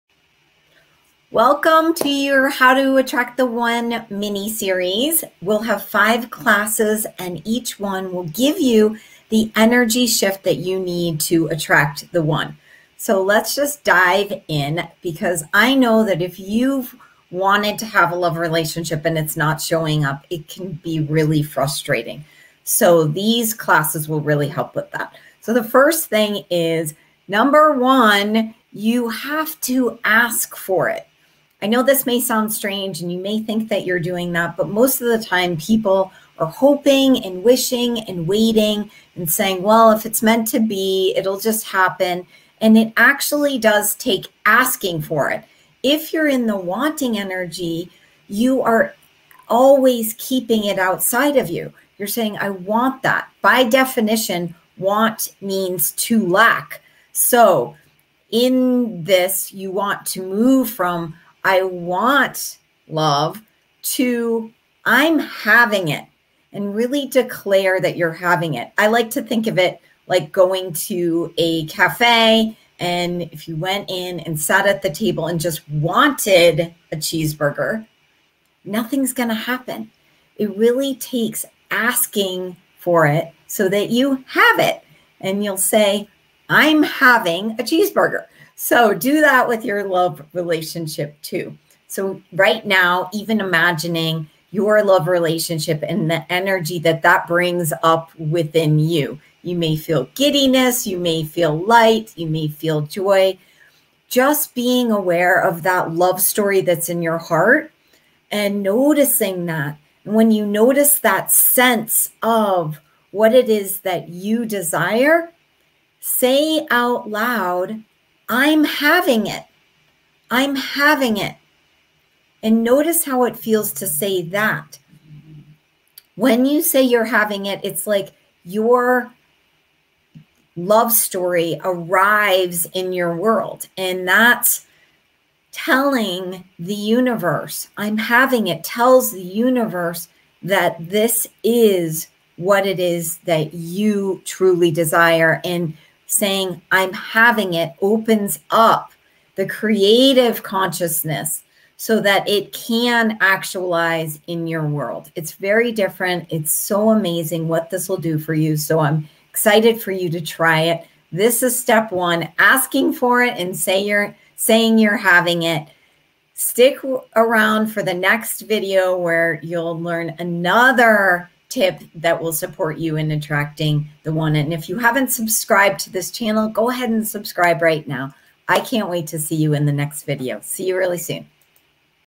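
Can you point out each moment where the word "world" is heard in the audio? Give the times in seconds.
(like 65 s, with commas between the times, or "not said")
133 s, 154 s.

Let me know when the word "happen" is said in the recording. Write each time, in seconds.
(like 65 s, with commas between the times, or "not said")
41 s, 79 s.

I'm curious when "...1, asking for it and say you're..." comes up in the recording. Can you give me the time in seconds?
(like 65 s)
161 s.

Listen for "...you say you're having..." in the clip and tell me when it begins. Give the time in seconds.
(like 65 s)
126 s.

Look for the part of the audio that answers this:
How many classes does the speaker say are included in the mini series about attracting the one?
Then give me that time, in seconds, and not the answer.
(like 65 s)
5 s.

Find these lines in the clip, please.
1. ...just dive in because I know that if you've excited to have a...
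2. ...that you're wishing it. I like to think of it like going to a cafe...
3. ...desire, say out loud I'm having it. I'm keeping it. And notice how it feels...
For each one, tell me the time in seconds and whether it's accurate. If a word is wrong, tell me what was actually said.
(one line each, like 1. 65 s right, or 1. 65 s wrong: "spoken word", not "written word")
1. 13 s wrong: "wanted", not "excited"
2. 67 s wrong: "having", not "wishing"
3. 114 s wrong: "having", not "keeping".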